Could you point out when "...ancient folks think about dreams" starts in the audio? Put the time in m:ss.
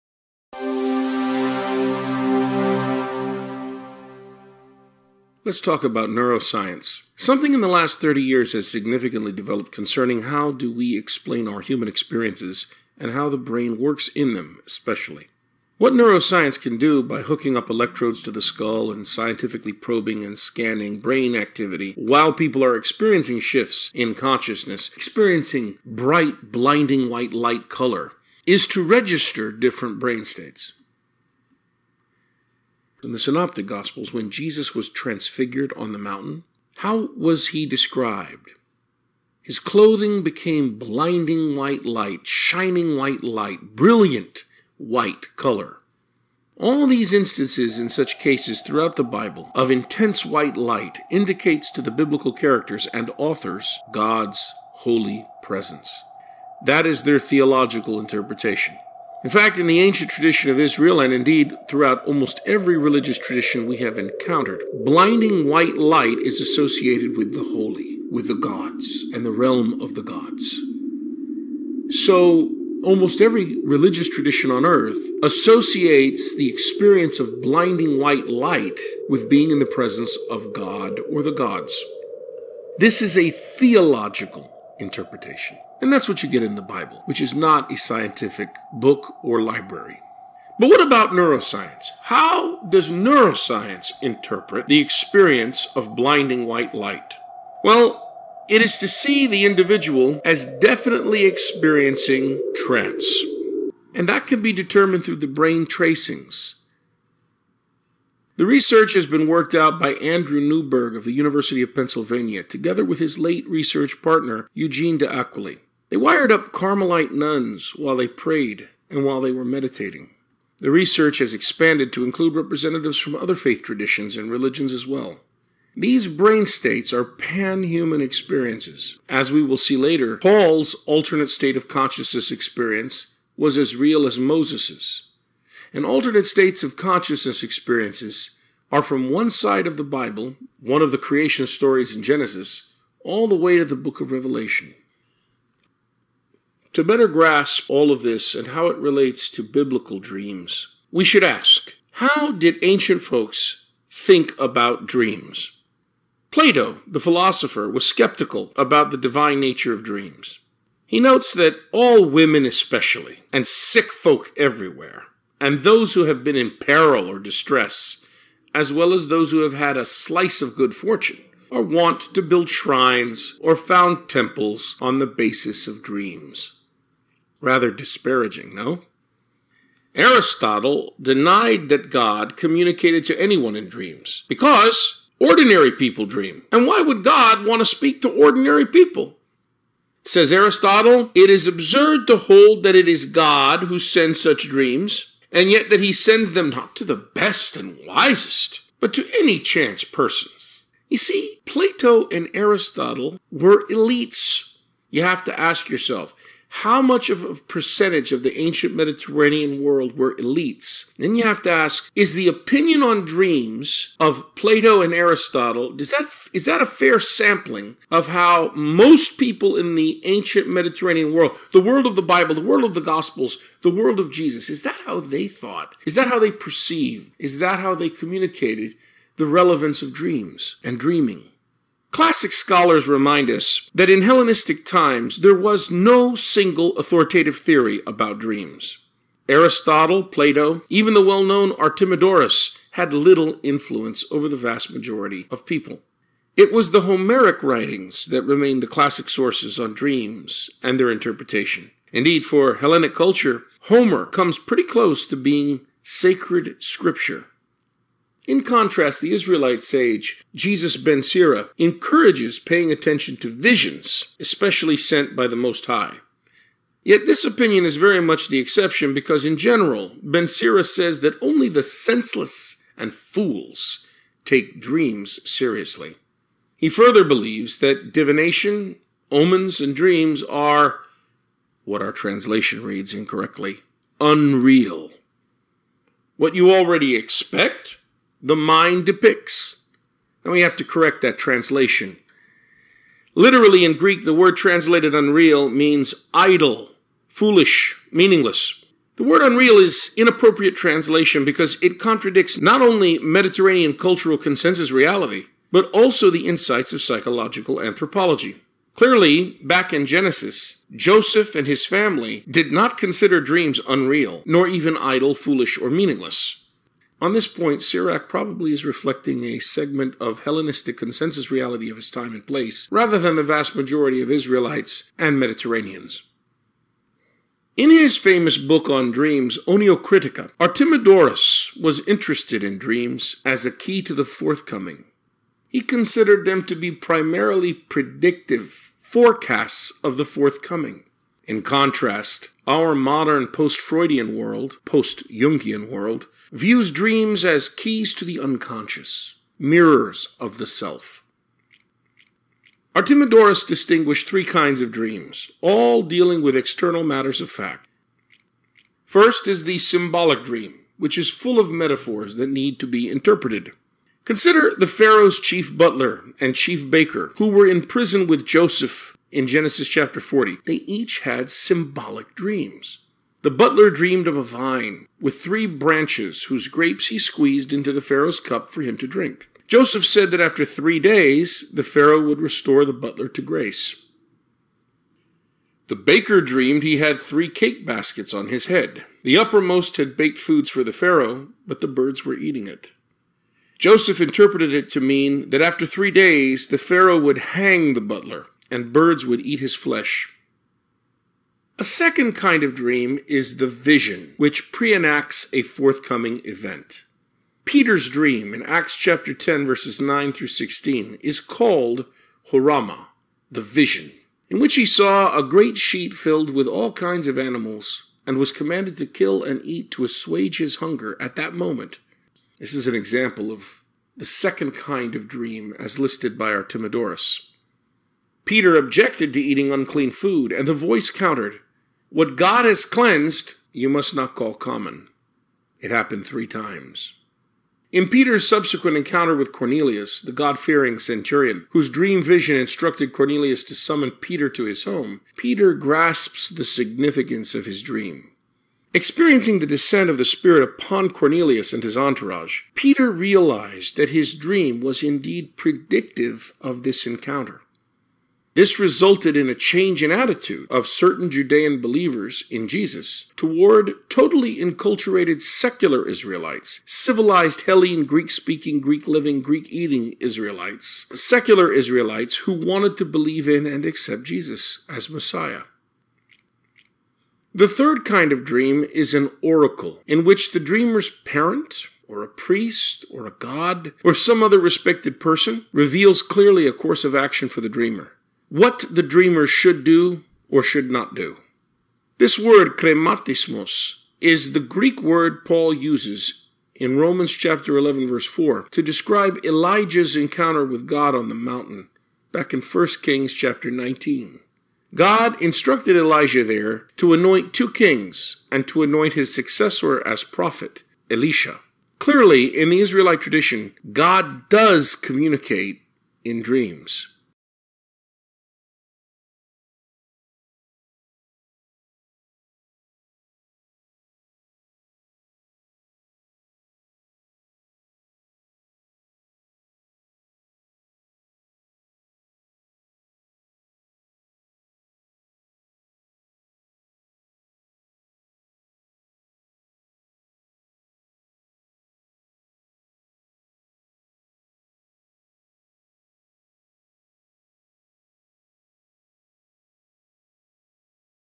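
2:32.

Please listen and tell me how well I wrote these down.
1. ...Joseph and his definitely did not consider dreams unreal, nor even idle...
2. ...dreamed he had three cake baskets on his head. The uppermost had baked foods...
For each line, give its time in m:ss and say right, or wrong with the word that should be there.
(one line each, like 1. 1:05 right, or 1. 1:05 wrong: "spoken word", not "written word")
1. 5:10 wrong: "family", not "definitely"
2. 6:26 right.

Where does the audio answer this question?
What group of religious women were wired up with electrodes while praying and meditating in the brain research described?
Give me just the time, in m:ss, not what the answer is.
1:56.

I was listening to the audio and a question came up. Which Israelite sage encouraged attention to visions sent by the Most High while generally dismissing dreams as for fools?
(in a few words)
Jesus ben Sira.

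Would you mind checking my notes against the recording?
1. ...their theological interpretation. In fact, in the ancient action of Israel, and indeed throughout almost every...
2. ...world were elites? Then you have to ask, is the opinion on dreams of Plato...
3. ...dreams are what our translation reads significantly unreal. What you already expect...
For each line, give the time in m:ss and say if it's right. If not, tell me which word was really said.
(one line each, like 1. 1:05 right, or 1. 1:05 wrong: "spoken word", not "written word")
1. 0:57 wrong: "tradition", not "action"
2. 3:29 right
3. 4:39 wrong: "incorrectly", not "significantly".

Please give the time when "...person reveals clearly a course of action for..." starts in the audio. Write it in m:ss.
8:05.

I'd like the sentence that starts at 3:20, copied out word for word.
You see, Plato and Aristotle were elites.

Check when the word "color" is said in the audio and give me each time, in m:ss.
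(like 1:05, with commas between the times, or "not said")
0:27, 0:45.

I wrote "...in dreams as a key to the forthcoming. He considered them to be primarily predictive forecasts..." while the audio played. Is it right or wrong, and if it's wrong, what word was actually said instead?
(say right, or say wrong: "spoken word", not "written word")
right.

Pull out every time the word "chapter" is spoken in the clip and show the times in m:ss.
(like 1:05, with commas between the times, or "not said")
6:09, 6:48, 8:17, 8:23.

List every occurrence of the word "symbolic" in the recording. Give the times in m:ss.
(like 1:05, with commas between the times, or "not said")
5:59, 6:11.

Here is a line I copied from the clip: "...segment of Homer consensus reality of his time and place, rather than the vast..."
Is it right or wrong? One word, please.
wrong.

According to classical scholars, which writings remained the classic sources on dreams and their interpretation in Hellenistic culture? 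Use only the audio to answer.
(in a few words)
Homeric writings.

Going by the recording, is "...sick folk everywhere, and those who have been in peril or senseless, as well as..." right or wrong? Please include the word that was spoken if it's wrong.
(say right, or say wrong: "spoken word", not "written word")
wrong: "distress", not "senseless".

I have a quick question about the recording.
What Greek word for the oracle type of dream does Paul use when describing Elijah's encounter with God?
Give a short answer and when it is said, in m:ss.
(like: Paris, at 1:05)
krematismos, at 8:12.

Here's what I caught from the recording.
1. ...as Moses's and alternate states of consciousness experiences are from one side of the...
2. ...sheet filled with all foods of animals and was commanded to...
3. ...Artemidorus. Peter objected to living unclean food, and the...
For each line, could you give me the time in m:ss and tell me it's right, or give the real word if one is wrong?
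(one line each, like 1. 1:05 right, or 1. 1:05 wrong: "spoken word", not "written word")
1. 2:14 right
2. 6:55 wrong: "kinds", not "foods"
3. 7:06 wrong: "eating", not "living".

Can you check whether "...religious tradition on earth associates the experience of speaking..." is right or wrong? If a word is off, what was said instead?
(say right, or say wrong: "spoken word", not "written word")
wrong: "blinding", not "speaking".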